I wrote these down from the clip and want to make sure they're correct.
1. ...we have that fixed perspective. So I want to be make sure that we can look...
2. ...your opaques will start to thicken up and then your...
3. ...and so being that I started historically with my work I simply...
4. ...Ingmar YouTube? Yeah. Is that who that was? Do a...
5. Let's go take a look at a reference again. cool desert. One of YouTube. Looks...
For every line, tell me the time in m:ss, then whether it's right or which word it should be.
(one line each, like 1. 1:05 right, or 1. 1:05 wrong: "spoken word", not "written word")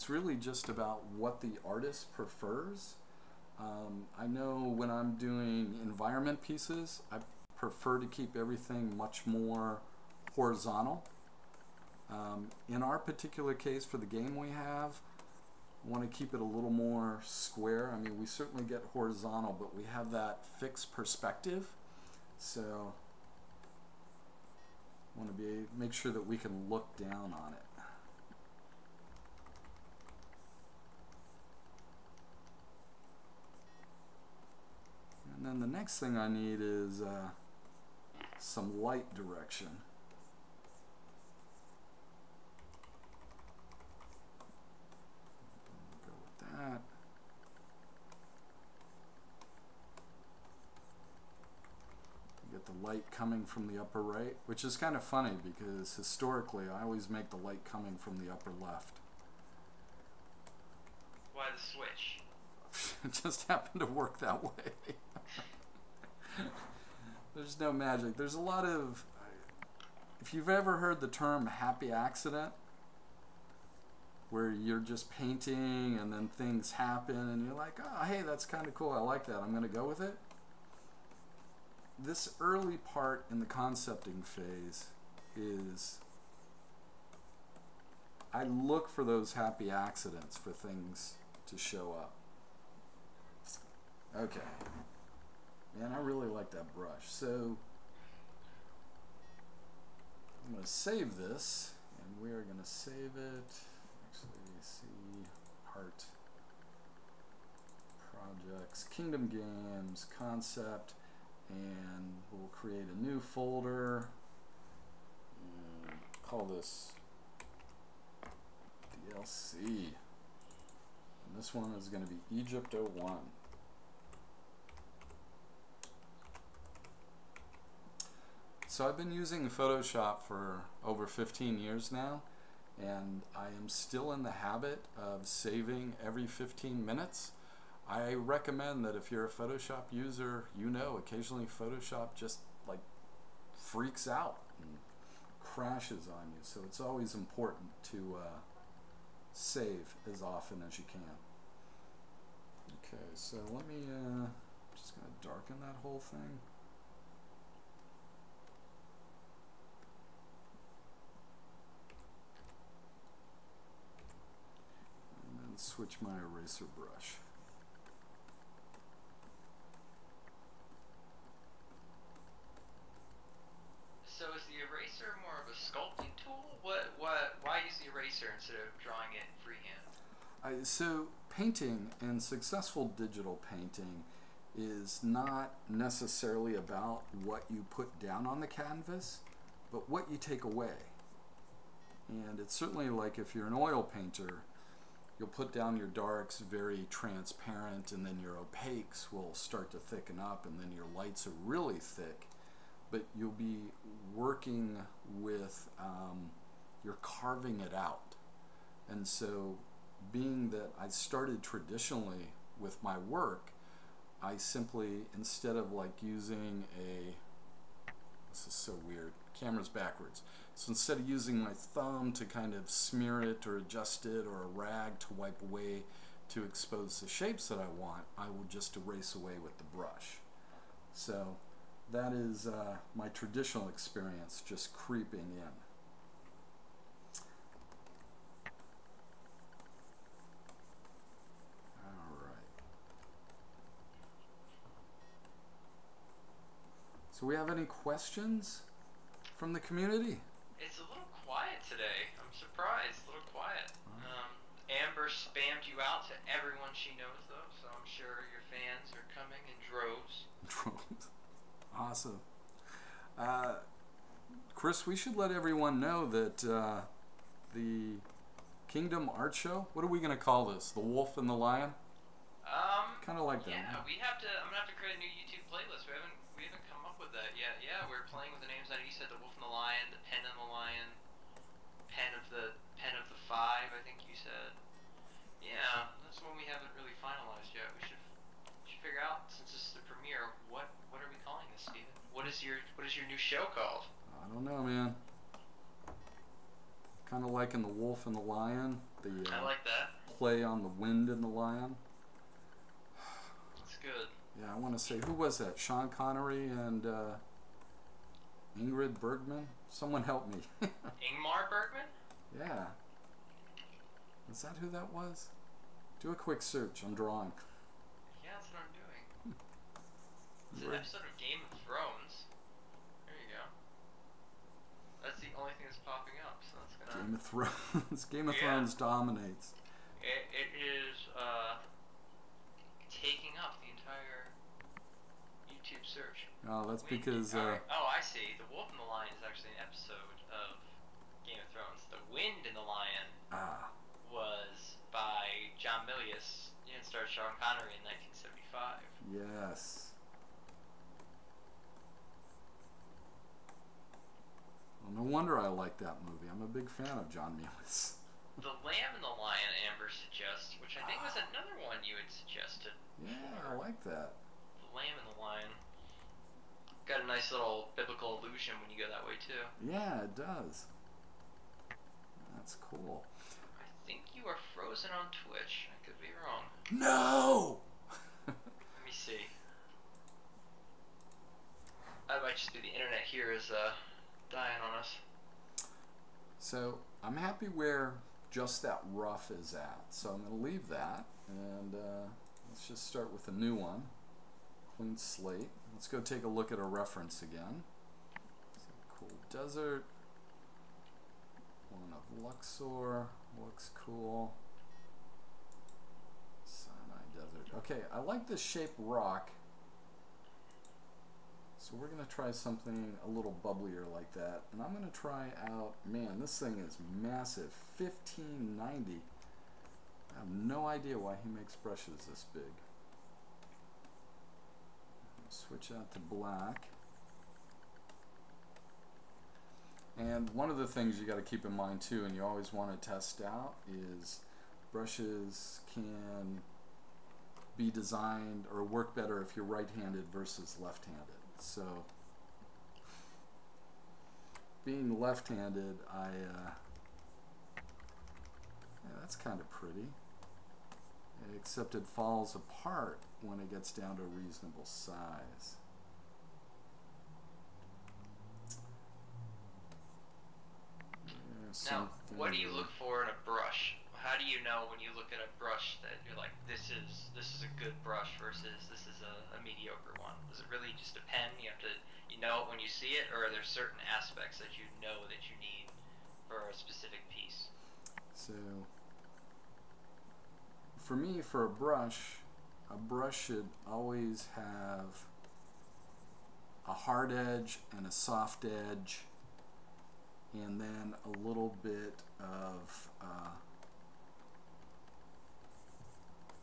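1. 0:19 right
2. 3:18 right
3. 3:28 wrong: "traditionally", not "historically"
4. 5:10 wrong: "Bergman", not "YouTube"
5. 6:35 wrong: "Luxor", not "YouTube".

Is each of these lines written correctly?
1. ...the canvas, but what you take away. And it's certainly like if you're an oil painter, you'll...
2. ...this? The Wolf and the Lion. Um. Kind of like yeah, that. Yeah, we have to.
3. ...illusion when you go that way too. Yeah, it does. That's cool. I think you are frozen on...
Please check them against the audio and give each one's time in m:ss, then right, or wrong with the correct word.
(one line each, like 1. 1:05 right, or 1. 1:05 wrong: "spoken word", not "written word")
1. 3:08 right
2. 4:30 right
3. 6:08 right.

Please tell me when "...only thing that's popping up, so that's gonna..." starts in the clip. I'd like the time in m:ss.
5:25.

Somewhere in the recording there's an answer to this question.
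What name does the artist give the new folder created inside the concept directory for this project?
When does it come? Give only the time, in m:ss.
1:59.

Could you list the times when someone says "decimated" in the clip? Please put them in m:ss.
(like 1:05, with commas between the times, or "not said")
not said.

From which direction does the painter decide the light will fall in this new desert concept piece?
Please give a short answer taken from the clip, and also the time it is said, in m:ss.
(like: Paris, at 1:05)
Upper right, at 0:53.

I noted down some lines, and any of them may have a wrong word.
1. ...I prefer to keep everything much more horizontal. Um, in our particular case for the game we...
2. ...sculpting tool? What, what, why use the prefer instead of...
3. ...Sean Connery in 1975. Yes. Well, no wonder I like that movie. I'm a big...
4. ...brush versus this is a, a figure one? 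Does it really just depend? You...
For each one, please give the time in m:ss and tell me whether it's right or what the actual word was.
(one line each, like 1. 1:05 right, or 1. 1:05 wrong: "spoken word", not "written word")
1. 0:07 right
2. 2:55 wrong: "eraser", not "prefer"
3. 5:47 right
4. 7:47 wrong: "mediocre", not "figure".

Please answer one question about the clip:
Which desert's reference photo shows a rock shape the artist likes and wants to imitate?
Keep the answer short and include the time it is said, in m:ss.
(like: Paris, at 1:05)
Sinai, at 6:46.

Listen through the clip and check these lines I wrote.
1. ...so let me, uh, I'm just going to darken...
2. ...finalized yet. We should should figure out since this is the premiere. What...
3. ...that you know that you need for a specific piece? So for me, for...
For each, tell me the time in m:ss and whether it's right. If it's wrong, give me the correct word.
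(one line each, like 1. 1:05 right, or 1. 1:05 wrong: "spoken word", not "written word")
1. 2:33 right
2. 4:47 right
3. 7:54 right.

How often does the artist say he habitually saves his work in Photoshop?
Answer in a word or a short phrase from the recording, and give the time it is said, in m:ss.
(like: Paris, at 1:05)
Every 15 minutes, at 2:16.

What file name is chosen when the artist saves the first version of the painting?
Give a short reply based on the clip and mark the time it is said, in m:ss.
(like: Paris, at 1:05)
Egypt 01, at 2:02.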